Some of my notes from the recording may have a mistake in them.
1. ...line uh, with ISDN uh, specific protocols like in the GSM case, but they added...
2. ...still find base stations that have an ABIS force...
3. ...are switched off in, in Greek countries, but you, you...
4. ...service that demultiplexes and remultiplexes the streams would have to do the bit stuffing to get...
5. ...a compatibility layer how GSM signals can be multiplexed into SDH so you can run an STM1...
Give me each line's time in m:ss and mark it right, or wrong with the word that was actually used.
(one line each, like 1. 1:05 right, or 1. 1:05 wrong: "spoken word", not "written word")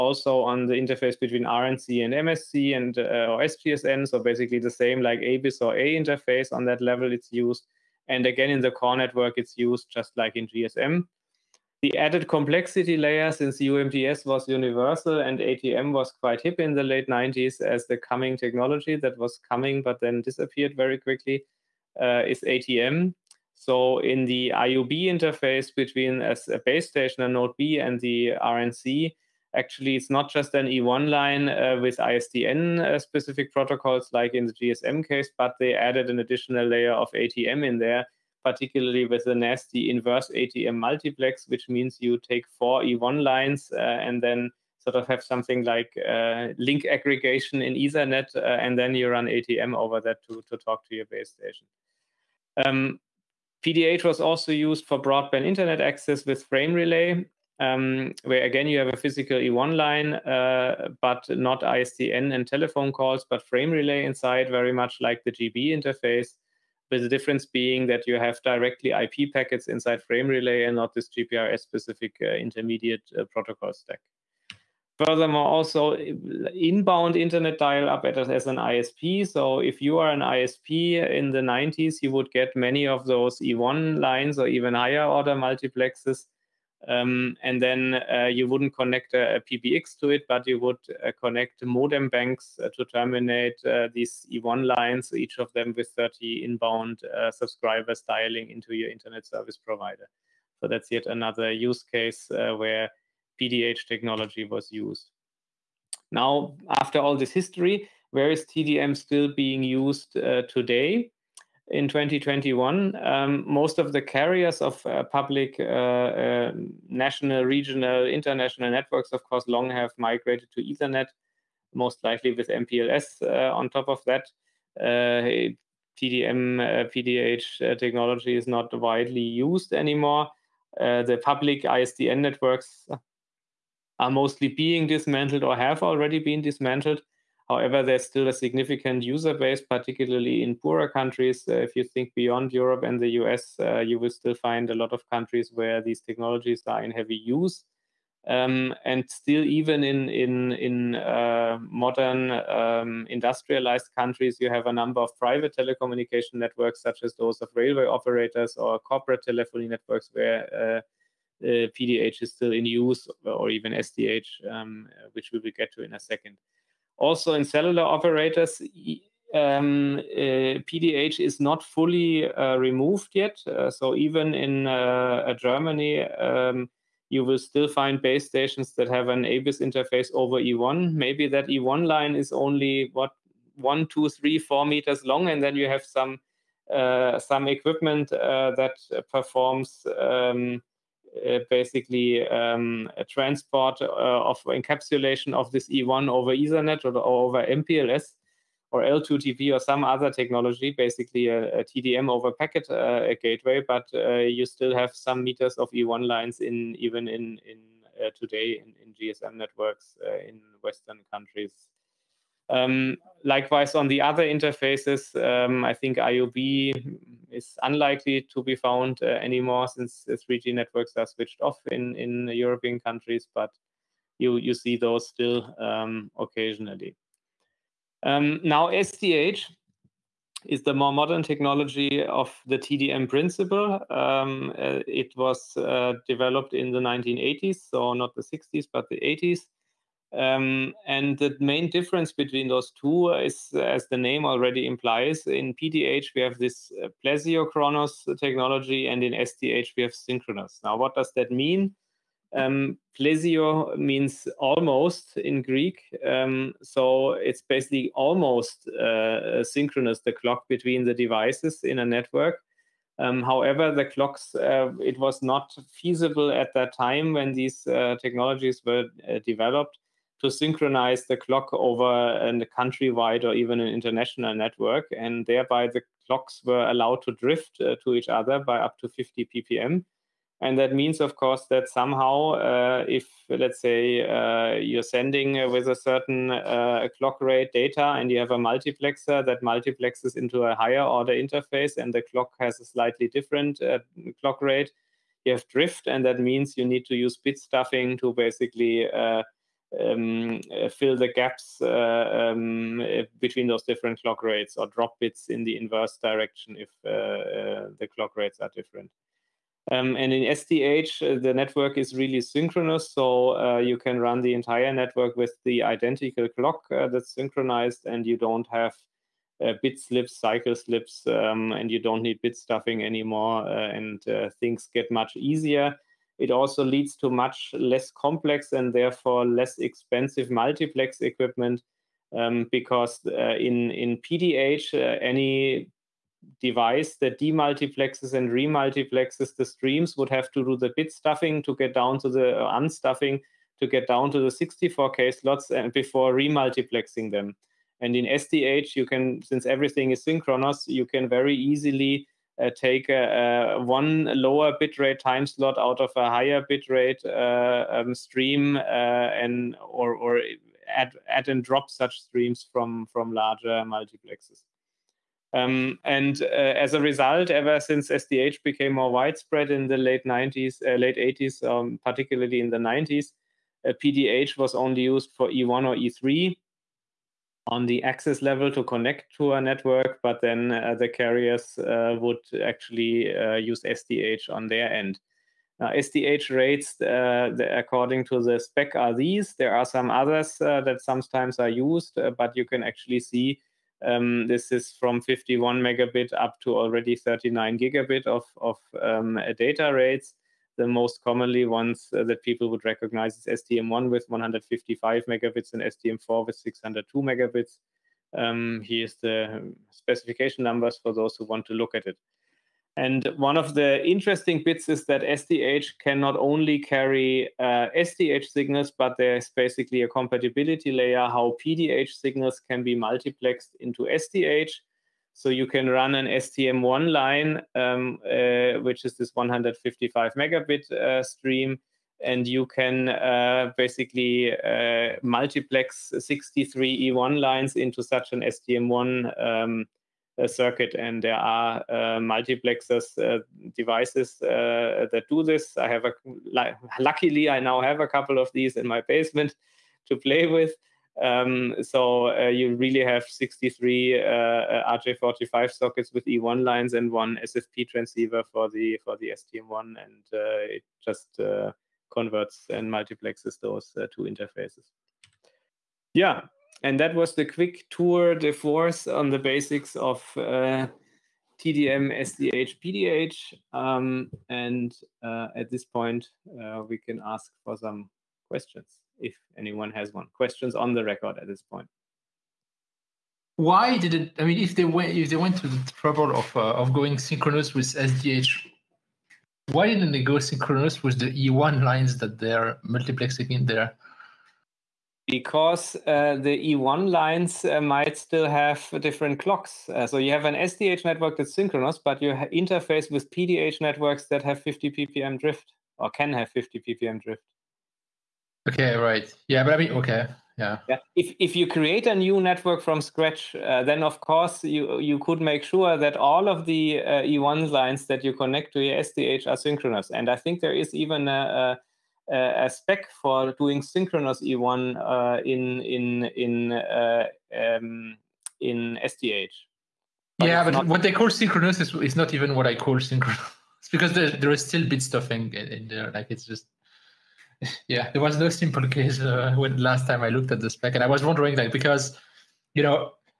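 1. 0:31 right
2. 2:57 wrong: "interface", not "force"
3. 3:40 wrong: "European", not "Greek"
4. 5:36 wrong: "device", not "service"
5. 6:59 wrong: "PDH", not "GSM".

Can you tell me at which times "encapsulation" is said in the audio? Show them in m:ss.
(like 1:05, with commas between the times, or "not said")
3:14.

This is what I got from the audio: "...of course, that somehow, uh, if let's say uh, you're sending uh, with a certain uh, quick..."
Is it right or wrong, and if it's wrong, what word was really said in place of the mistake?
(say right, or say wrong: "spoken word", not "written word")
wrong: "clock", not "quick".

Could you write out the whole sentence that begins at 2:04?
Uh, TDM, PDH uh, technology is not widely used anymore.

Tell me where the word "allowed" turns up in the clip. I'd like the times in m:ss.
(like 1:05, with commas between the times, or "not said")
4:36.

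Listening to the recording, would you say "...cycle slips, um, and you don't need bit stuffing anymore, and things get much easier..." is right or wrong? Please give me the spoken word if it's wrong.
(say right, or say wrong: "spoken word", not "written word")
right.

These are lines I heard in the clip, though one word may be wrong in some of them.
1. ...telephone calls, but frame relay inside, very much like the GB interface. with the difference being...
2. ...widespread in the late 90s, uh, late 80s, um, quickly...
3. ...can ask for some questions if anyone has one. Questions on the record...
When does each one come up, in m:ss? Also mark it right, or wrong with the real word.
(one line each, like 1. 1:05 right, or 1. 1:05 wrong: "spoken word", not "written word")
1. 1:02 right
2. 6:08 wrong: "particularly", not "quickly"
3. 7:56 right.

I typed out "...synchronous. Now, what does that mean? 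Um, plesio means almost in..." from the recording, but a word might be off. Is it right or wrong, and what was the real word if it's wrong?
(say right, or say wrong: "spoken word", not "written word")
right.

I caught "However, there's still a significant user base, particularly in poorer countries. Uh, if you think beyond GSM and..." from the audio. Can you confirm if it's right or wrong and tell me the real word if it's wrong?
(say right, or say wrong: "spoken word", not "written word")
wrong: "Europe", not "GSM".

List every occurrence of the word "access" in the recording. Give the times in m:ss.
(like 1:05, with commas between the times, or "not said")
0:55, 6:17.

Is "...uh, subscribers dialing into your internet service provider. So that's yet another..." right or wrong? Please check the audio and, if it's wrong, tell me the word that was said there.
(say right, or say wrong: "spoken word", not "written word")
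right.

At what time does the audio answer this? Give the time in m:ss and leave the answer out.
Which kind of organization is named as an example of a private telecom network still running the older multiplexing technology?
2:37.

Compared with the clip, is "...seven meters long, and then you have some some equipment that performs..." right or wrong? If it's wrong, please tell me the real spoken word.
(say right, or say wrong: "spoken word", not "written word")
wrong: "four", not "seven".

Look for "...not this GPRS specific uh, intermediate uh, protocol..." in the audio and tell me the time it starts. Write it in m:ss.
1:10.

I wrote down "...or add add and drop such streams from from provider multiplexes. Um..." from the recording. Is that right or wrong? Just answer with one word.
wrong.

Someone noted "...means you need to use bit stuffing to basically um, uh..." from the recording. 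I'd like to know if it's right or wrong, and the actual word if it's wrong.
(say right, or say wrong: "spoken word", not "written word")
right.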